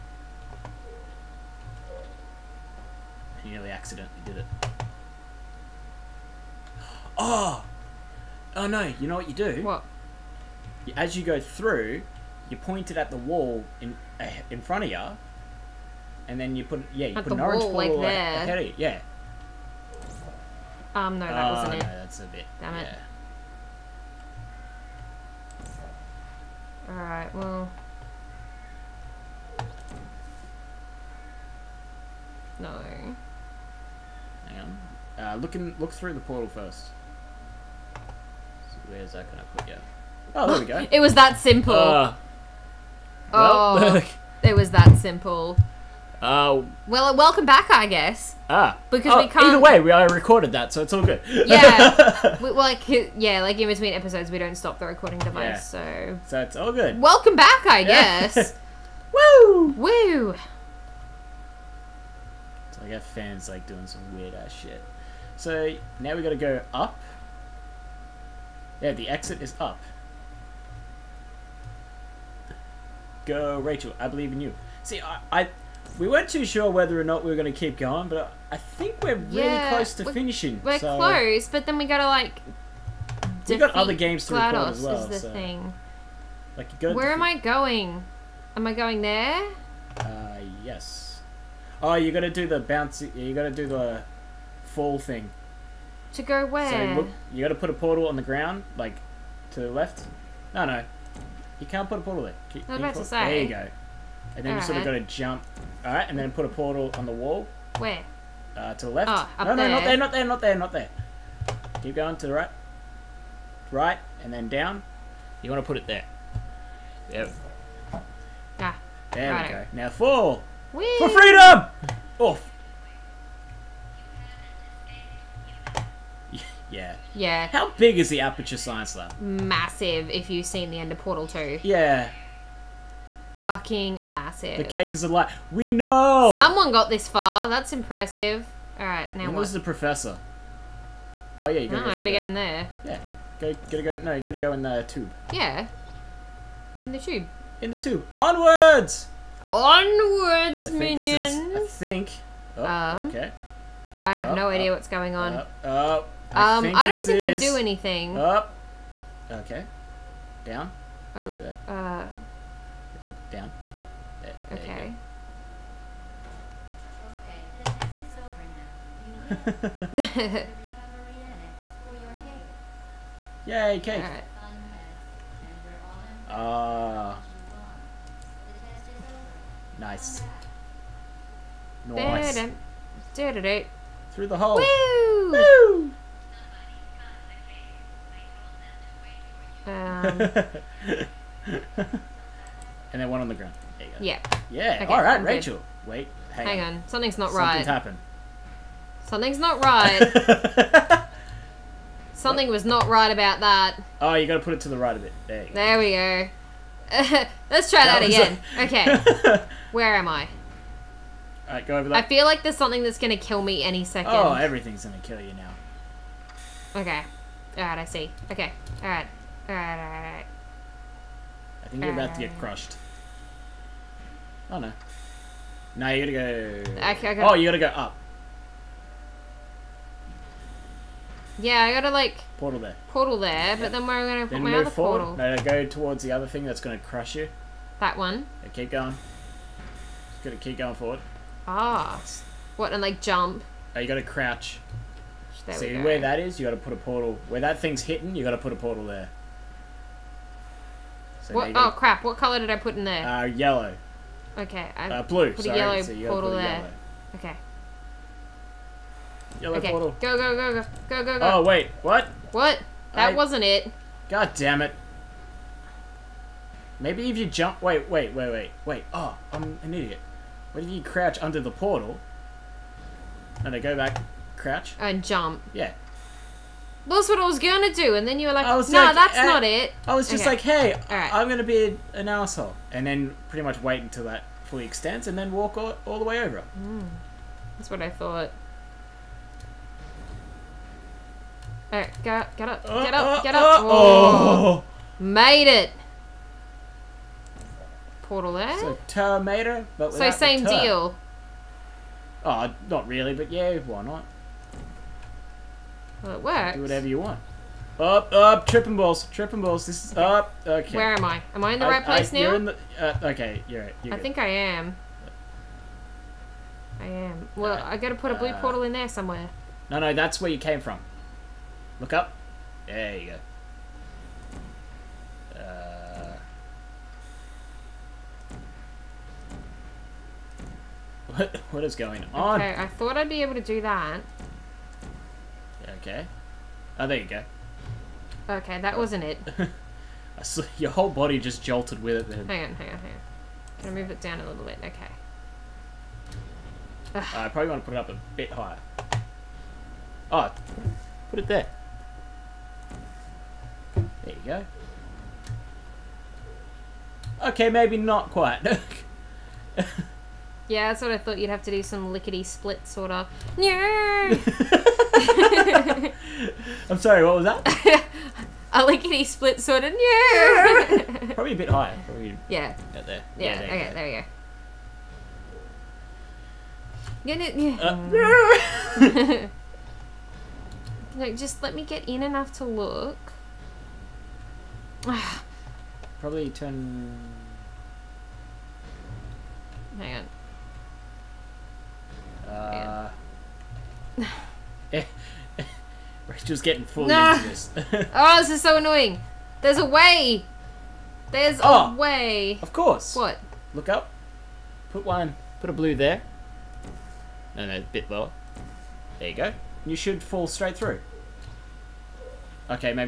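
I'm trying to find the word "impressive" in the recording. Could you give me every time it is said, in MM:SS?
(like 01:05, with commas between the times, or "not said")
02:17.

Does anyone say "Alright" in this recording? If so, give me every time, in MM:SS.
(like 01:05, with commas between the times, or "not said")
02:18, 03:39.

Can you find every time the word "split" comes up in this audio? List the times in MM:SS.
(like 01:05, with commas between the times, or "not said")
06:02, 06:09.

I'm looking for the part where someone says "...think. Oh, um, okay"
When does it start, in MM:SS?
02:31.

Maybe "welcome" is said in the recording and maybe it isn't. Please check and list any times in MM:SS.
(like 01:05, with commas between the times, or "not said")
00:47, 00:57.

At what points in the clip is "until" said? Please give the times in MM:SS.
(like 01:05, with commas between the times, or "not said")
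04:43.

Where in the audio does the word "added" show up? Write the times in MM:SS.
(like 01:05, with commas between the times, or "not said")
not said.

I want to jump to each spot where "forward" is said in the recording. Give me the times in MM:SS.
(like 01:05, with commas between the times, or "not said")
03:54, 04:00.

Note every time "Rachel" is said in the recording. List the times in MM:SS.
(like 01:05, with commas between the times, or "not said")
01:13, 03:15, 06:36.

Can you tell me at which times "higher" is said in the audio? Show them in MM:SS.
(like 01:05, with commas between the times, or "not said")
05:48, 06:11.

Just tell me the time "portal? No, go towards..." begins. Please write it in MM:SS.
03:55.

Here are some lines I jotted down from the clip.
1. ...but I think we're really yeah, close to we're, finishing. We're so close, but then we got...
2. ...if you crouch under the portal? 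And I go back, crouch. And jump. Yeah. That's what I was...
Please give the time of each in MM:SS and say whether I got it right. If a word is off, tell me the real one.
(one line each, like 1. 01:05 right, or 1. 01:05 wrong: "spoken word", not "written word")
1. 01:18 right
2. 04:30 right.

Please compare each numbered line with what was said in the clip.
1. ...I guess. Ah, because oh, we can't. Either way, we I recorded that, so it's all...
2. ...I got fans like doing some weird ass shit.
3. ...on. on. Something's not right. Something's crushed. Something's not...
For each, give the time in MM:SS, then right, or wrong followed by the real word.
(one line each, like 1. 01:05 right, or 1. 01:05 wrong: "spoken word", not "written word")
1. 00:47 right
2. 01:02 right
3. 03:16 wrong: "happened", not "crushed".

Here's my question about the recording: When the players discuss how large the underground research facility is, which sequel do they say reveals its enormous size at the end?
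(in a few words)
Portal 2.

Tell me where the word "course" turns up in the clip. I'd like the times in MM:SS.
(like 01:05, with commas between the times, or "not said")
06:42.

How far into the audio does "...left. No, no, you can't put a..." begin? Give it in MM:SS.
01:39.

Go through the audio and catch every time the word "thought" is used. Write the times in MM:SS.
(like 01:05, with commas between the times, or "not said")
04:47, 05:32, 06:00.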